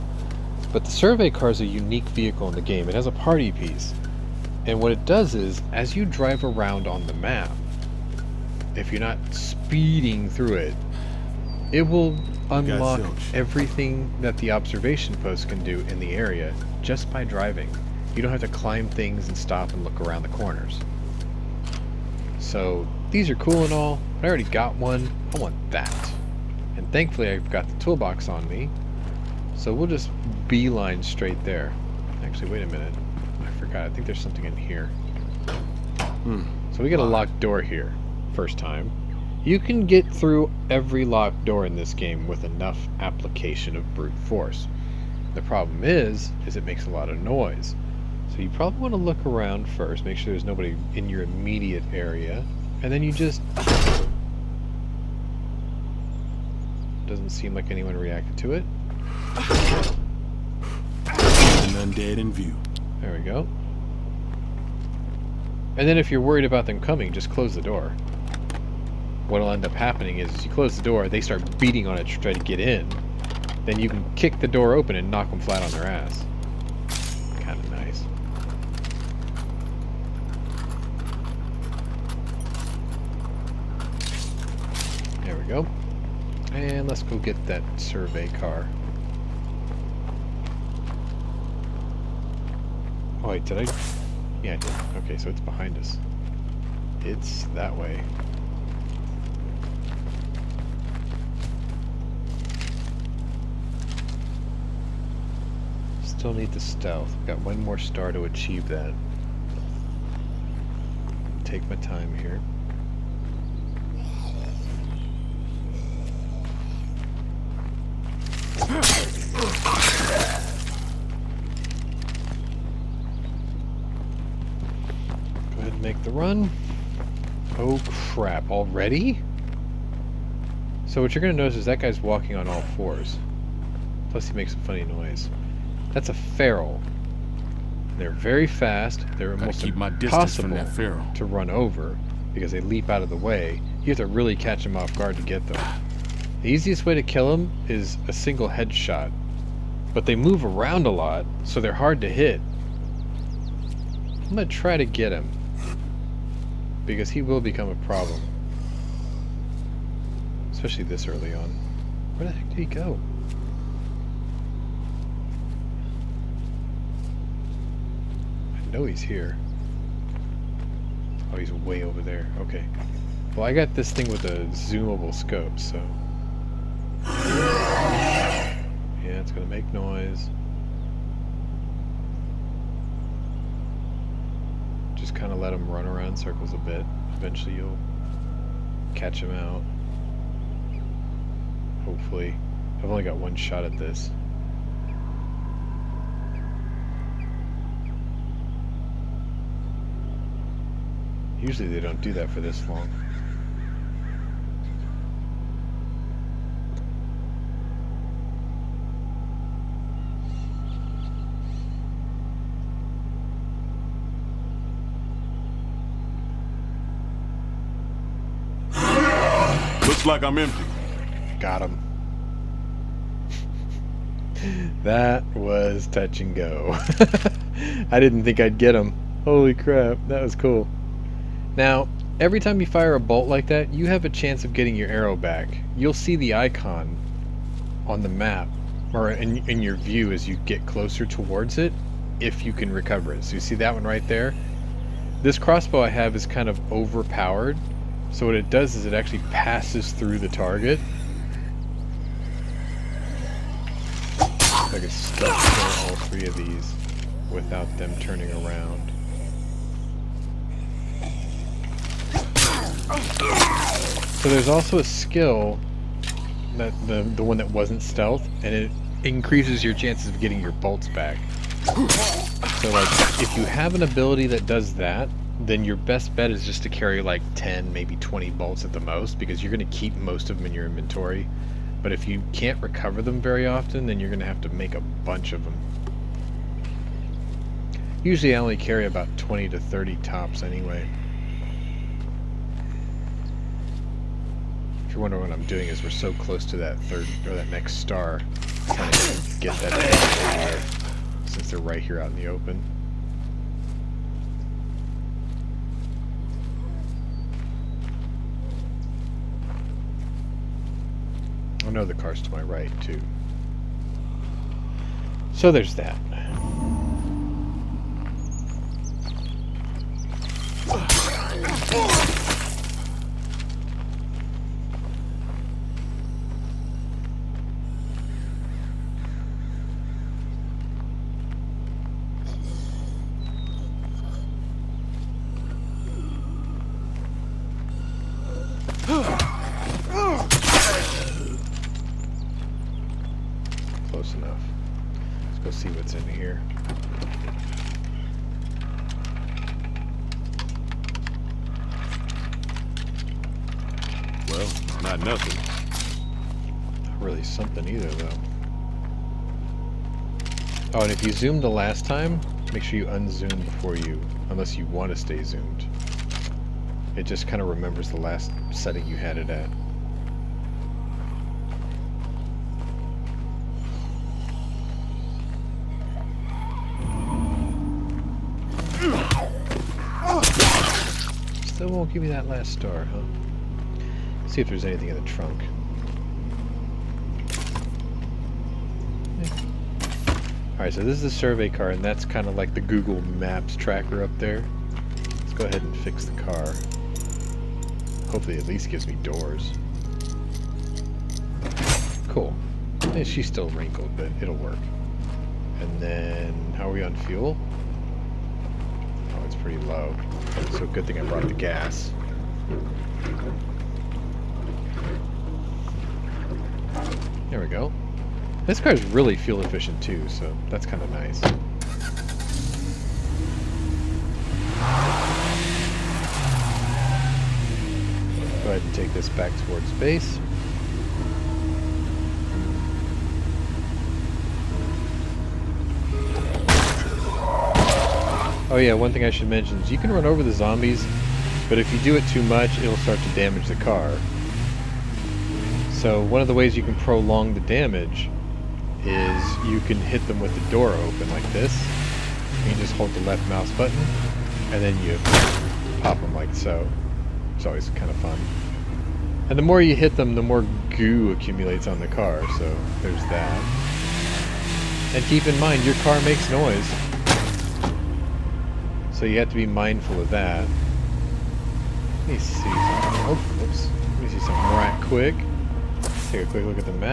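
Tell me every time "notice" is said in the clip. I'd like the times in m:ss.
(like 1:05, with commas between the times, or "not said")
2:11.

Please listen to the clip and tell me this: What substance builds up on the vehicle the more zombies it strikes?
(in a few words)
Goo.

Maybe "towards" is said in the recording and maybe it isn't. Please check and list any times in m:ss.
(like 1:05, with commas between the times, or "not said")
4:01, 7:09.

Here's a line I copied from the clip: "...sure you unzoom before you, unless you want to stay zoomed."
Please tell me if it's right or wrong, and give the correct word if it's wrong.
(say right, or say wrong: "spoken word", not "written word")
right.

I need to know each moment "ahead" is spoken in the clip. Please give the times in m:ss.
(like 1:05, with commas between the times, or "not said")
1:58, 6:35, 7:08.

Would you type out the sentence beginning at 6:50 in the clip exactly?
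So good thing I brought the gas.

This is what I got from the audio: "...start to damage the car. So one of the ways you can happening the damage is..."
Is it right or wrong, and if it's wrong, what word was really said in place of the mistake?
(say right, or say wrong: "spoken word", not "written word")
wrong: "prolong", not "happening".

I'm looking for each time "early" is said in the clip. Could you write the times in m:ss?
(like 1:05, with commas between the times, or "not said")
2:41.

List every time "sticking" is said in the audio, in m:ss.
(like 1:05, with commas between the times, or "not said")
not said.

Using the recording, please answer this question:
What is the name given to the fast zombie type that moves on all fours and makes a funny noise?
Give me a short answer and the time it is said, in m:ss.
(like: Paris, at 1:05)
Feral, at 2:15.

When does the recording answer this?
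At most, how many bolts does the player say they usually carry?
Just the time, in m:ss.
4:49.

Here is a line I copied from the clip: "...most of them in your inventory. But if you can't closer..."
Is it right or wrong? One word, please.
wrong.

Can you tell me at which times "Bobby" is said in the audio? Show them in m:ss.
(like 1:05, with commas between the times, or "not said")
not said.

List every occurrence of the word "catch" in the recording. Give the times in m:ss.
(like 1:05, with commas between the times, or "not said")
2:24, 3:08.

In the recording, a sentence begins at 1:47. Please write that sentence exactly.
got one more star to achieve that.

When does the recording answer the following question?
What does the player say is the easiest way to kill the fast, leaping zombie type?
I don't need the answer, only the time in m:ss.
2:28.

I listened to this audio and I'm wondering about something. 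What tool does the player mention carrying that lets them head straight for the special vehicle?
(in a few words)
Toolbox.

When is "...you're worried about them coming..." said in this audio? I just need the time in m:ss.
1:06.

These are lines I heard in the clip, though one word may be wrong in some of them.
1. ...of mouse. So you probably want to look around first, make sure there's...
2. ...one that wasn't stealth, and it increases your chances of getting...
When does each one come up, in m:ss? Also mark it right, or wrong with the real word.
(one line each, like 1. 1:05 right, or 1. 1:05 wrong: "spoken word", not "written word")
1. 0:47 wrong: "noise", not "mouse"
2. 4:27 right.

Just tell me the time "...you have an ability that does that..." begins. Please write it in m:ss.
4:33.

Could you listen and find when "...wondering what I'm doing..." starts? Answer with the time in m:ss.
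4:55.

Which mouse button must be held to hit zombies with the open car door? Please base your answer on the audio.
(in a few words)
Left mouse button.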